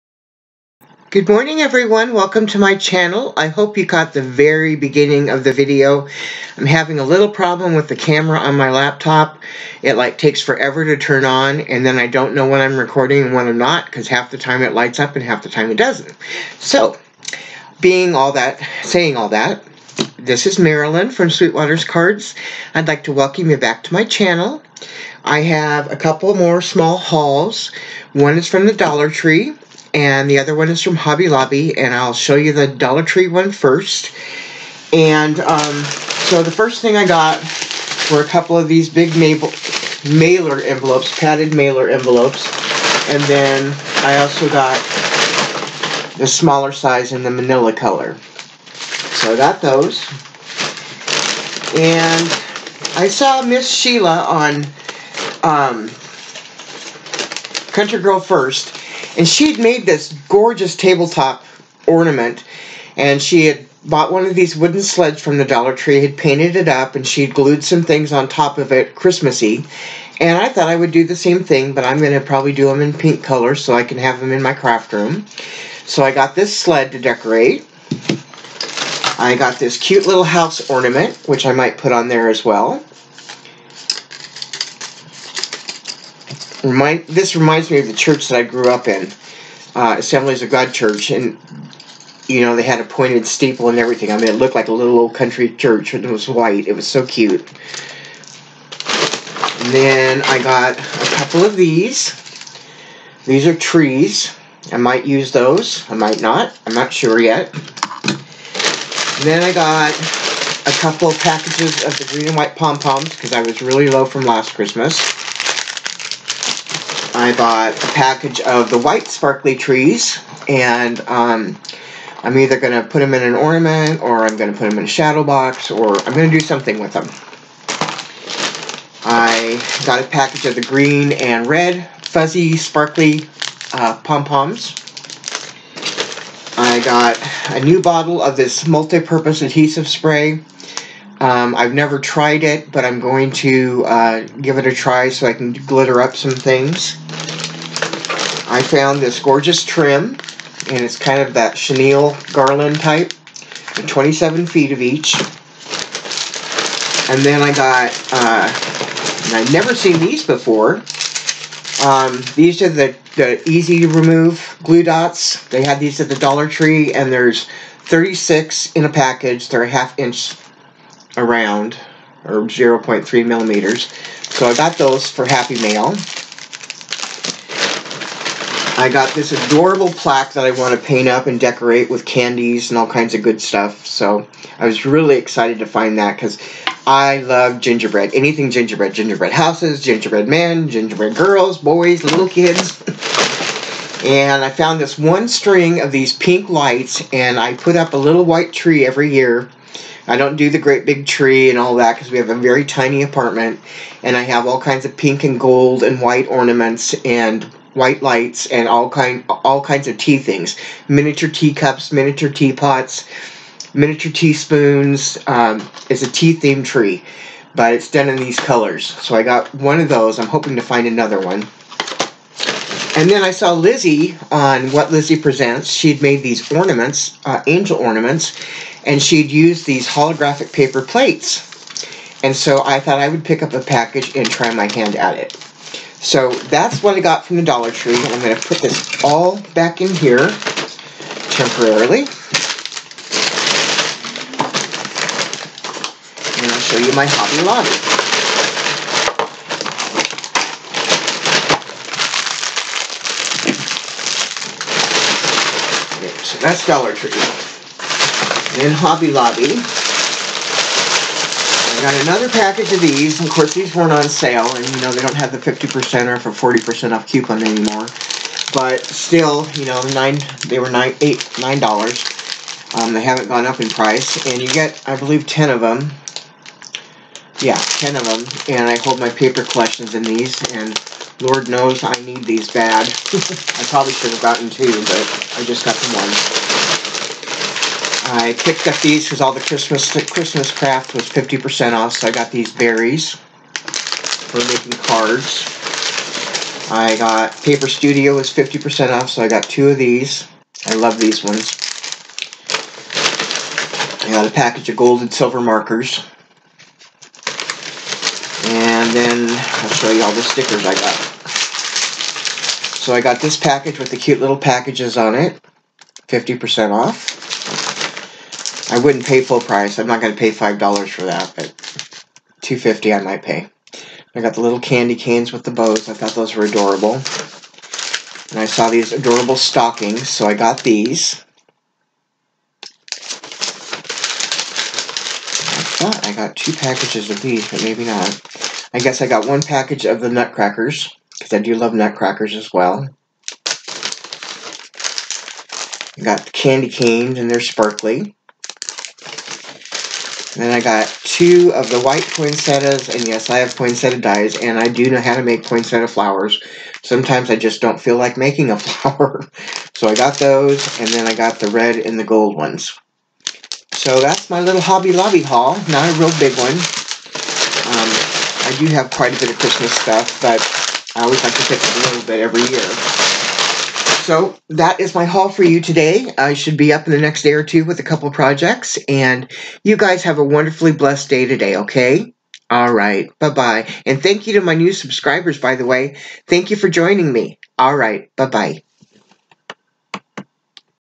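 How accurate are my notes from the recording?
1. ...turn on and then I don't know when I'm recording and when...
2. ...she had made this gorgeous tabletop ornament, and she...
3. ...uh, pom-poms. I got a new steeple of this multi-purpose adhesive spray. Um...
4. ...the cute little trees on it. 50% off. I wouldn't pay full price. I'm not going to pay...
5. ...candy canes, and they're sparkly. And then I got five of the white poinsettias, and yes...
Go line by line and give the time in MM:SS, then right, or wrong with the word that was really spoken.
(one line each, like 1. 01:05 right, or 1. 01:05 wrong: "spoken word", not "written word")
1. 00:10 right
2. 00:59 right
3. 02:13 wrong: "bottle", not "steeple"
4. 05:13 wrong: "packages", not "trees"
5. 05:46 wrong: "two", not "five".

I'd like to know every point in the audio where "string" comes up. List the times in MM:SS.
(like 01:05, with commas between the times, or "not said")
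03:15.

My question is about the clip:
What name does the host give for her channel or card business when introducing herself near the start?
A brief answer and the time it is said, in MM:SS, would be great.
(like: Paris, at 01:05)
Sweetwater's Cards, at 00:21.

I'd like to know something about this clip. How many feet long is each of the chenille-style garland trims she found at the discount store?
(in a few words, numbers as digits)
27 feet.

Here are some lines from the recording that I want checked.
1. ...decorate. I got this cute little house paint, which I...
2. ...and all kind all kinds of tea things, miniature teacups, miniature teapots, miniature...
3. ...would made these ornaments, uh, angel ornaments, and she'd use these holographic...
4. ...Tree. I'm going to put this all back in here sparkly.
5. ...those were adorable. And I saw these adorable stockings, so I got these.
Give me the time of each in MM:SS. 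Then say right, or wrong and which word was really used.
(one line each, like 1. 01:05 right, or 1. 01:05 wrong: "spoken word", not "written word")
1. 01:16 wrong: "ornament", not "paint"
2. 03:28 right
3. 03:45 right
4. 03:57 wrong: "temporarily", not "sparkly"
5. 05:26 right.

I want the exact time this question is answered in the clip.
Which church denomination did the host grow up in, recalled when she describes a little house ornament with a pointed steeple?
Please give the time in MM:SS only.
01:29.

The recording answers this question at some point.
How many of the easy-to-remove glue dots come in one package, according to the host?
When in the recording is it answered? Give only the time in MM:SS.
02:47.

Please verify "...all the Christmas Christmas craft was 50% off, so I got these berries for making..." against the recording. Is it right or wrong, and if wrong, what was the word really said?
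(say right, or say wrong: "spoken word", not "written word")
right.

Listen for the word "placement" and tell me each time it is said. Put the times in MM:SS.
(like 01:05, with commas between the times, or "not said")
not said.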